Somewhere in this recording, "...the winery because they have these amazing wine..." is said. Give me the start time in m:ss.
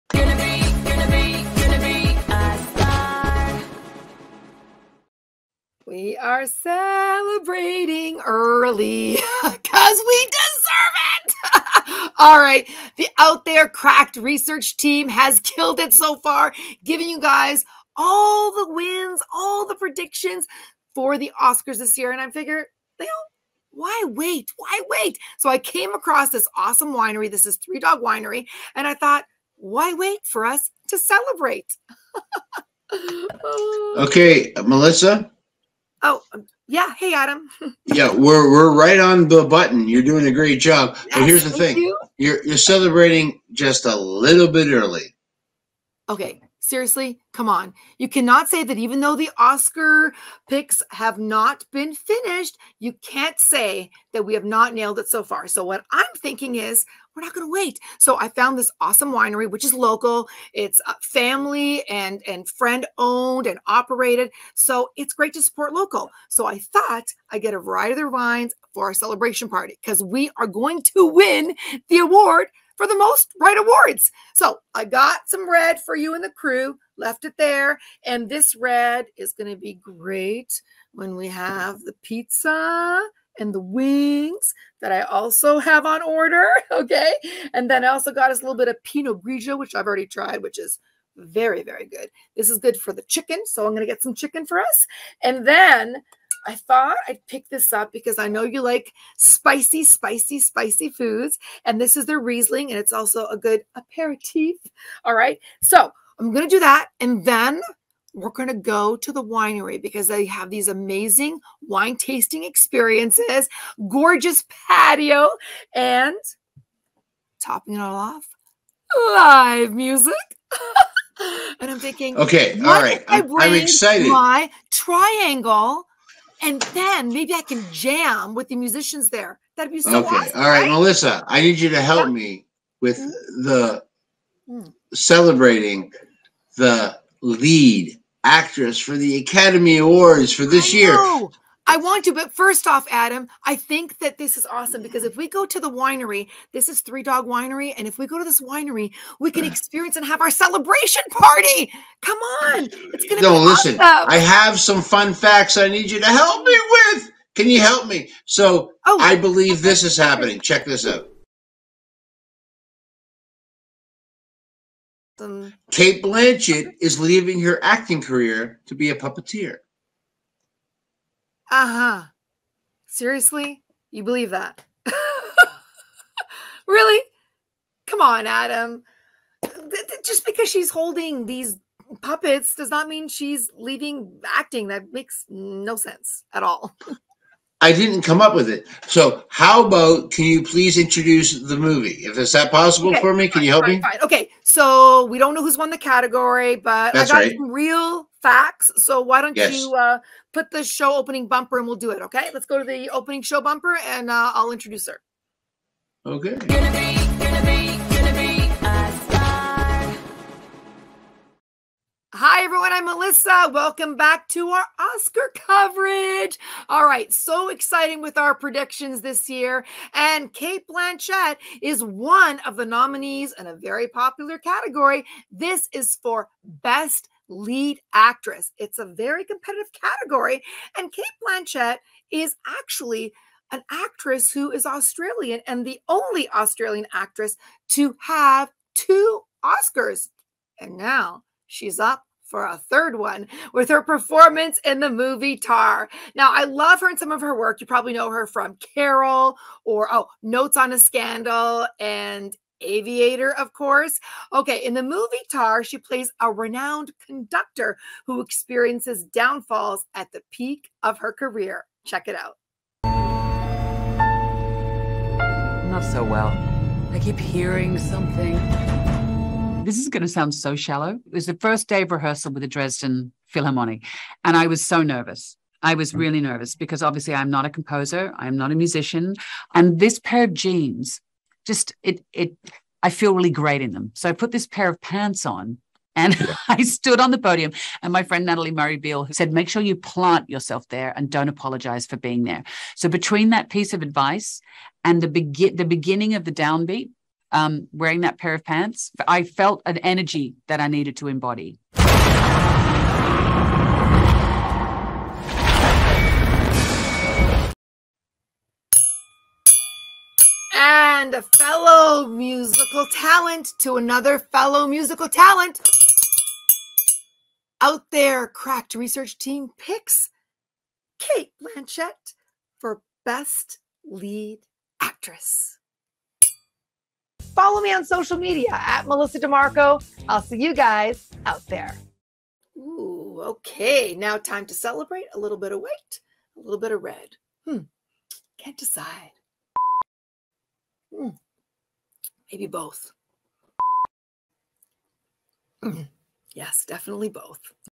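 1:49.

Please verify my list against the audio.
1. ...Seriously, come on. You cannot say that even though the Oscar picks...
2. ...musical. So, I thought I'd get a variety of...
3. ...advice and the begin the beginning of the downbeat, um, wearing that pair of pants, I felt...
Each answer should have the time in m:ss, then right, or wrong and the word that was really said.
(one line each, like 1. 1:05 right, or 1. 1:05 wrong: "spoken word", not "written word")
1. 0:46 right
2. 1:05 wrong: "local", not "musical"
3. 4:53 right.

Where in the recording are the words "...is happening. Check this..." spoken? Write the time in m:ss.
2:39.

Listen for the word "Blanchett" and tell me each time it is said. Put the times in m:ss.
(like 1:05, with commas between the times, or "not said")
2:46, 3:40, 3:51, 5:21.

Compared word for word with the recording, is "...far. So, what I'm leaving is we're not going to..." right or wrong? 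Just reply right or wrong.
wrong.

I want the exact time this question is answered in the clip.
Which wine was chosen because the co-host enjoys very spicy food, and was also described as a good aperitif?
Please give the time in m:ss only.
1:42.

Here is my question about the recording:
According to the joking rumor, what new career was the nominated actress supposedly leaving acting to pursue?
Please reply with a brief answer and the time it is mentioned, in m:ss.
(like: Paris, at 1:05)
puppeteer, at 2:48.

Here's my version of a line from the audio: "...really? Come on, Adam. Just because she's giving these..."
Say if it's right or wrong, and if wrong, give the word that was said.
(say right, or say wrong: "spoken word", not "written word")
wrong: "holding", not "giving".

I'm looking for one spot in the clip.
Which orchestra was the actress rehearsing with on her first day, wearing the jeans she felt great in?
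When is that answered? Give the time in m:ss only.
4:32.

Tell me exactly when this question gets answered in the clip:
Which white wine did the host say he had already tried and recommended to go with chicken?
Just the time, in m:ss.
1:28.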